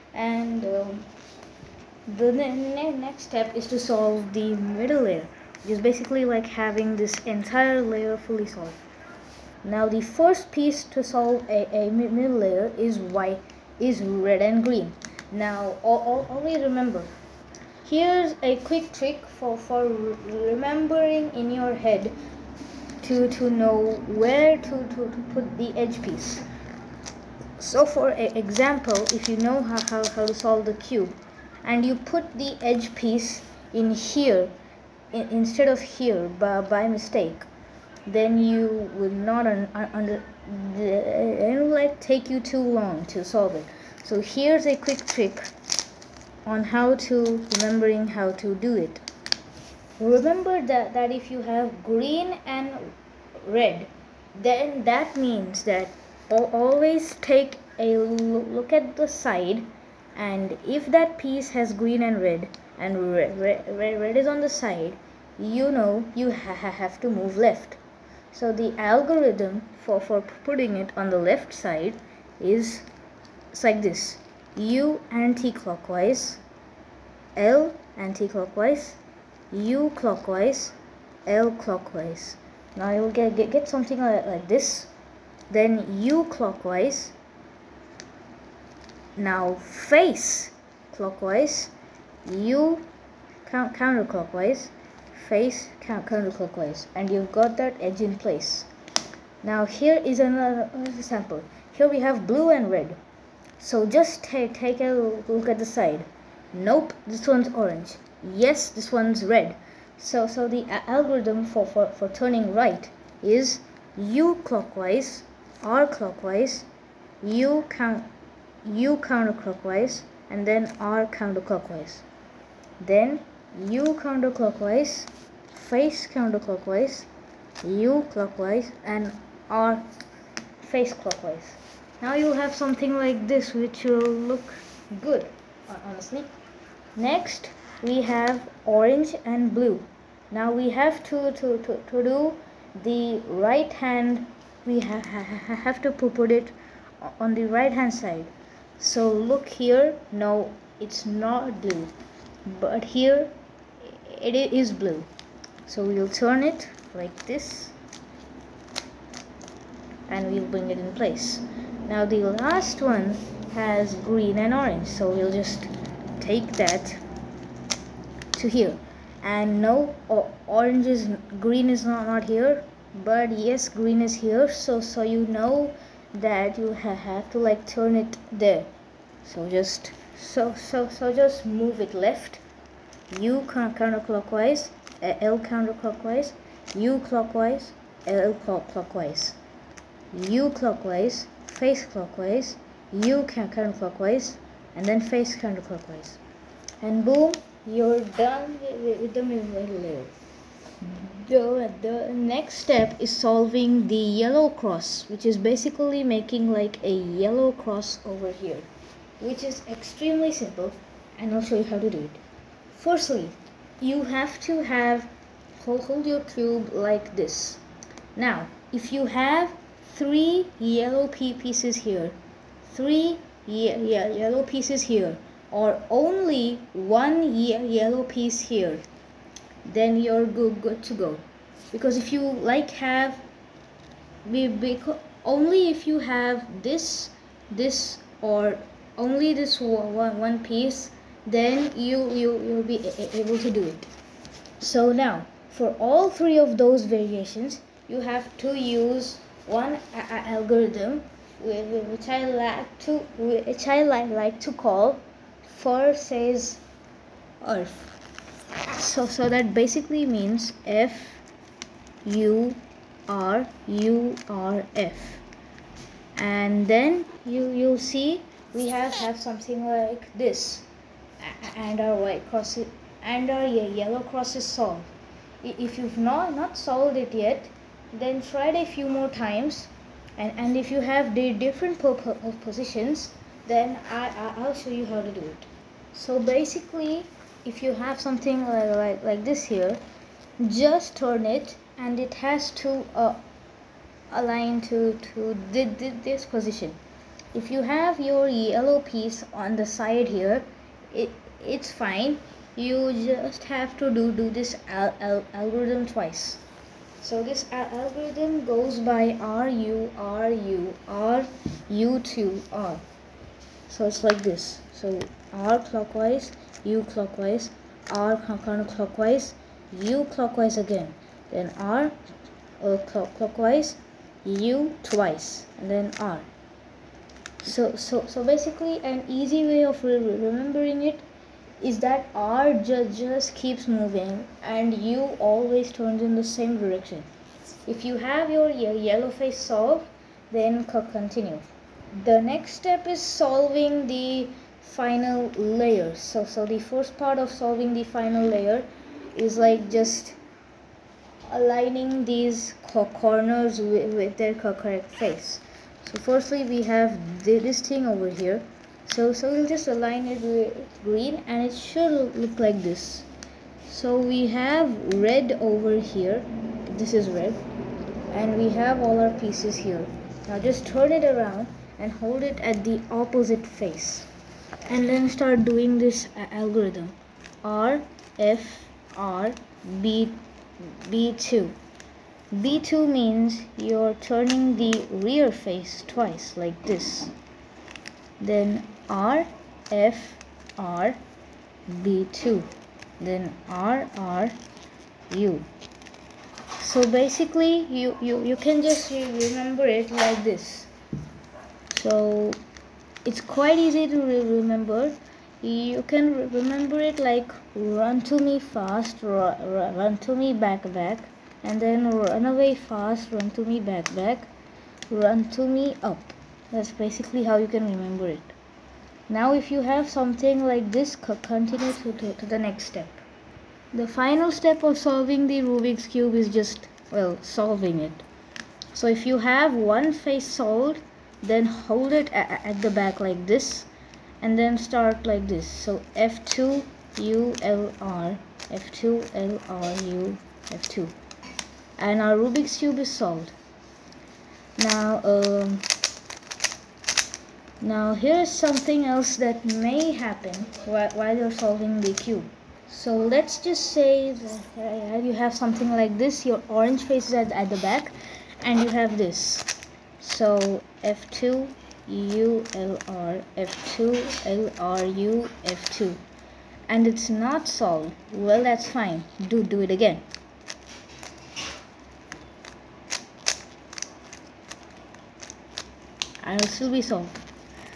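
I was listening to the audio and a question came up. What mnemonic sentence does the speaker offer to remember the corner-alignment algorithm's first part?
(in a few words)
run to me fast.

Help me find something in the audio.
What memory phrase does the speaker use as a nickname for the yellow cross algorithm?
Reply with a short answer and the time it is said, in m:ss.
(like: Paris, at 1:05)
for says earth, at 4:15.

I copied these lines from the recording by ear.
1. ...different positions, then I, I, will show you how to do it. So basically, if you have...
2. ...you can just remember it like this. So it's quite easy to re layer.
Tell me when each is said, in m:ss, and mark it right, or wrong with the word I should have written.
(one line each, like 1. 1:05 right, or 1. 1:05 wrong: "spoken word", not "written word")
1. 4:41 right
2. 6:38 wrong: "remember", not "layer".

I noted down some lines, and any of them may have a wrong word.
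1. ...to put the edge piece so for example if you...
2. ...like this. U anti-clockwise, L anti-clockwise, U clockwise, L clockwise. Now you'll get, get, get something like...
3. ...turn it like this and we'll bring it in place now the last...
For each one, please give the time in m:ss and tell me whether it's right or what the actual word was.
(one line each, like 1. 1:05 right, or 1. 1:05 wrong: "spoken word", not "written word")
1. 0:25 right
2. 1:13 right
3. 2:36 right.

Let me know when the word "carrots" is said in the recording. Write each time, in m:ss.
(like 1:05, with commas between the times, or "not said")
not said.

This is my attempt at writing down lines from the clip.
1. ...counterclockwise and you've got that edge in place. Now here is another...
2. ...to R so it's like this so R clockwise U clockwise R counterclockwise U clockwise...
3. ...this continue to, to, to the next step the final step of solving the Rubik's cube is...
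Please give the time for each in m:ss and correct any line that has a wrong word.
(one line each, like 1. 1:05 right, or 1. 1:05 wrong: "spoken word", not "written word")
1. 1:35 right
2. 5:12 right
3. 7:00 right.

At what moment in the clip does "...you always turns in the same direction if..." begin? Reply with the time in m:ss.
5:34.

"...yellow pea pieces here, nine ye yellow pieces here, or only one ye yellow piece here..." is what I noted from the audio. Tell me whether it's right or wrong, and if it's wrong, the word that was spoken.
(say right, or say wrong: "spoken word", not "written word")
wrong: "three", not "nine".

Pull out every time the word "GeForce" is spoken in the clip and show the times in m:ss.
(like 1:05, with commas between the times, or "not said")
not said.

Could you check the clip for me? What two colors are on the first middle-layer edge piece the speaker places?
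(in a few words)
red and green.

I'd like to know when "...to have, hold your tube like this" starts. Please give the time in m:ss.
3:34.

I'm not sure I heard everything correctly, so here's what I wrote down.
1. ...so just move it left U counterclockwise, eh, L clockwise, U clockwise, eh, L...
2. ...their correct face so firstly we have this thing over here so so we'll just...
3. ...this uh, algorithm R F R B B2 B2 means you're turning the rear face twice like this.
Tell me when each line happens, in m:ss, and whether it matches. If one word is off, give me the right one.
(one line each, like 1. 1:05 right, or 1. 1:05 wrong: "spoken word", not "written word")
1. 3:00 wrong: "counterclockwise", not "clockwise"
2. 5:54 right
3. 6:15 right.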